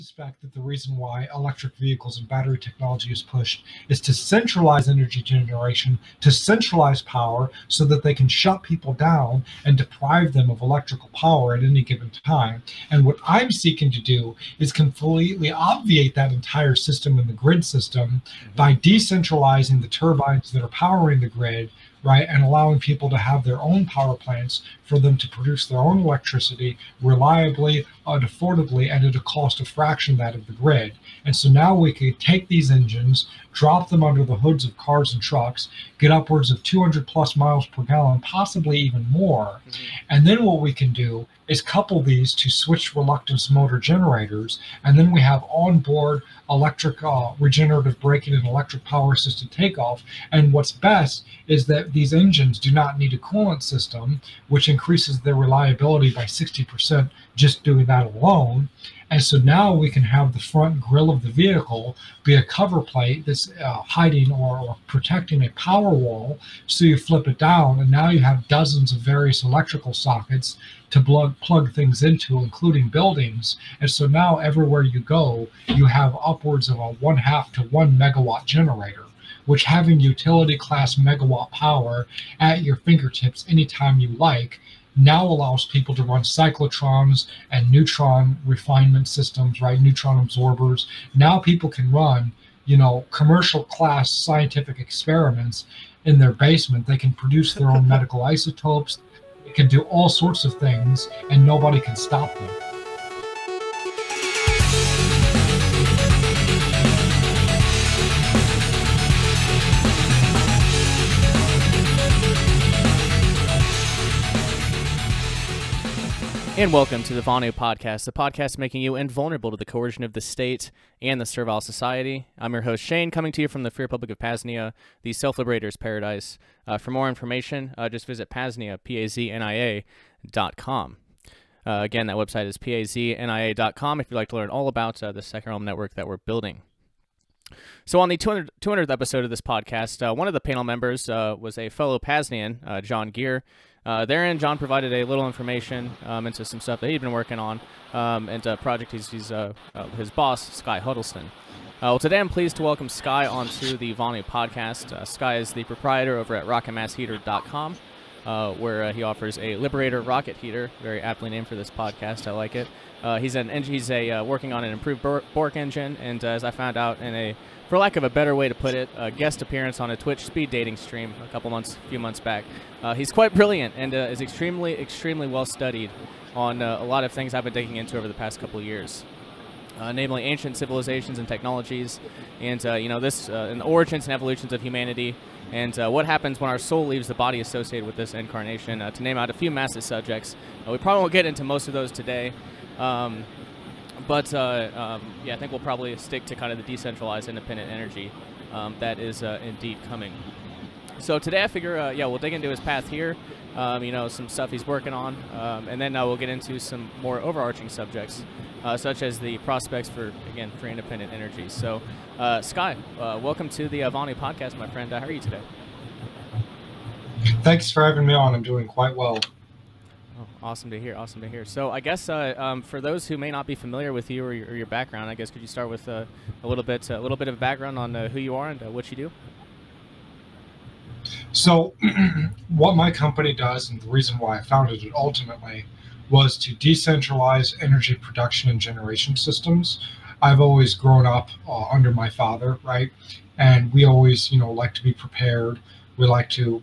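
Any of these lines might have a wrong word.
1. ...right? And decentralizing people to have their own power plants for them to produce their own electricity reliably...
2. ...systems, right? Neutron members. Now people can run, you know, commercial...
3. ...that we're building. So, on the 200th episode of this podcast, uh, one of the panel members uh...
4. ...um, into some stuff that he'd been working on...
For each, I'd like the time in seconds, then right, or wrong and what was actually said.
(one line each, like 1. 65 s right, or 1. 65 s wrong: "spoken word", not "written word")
1. 22 s wrong: "allowing", not "decentralizing"
2. 89 s wrong: "absorbers", not "members"
3. 135 s right
4. 146 s right.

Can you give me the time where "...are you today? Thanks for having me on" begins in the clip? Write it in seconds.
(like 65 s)
215 s.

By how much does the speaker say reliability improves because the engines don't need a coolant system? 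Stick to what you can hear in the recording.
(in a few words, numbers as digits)
60%.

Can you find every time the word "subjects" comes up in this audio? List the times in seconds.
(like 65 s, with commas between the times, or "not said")
189 s, 207 s.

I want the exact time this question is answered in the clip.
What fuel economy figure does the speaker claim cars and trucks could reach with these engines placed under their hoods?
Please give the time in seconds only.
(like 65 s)
36 s.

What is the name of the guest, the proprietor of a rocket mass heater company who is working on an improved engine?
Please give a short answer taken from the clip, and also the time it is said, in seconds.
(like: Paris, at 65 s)
Sky Huddleston, at 150 s.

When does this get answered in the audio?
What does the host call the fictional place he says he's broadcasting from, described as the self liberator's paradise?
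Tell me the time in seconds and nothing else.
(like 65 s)
123 s.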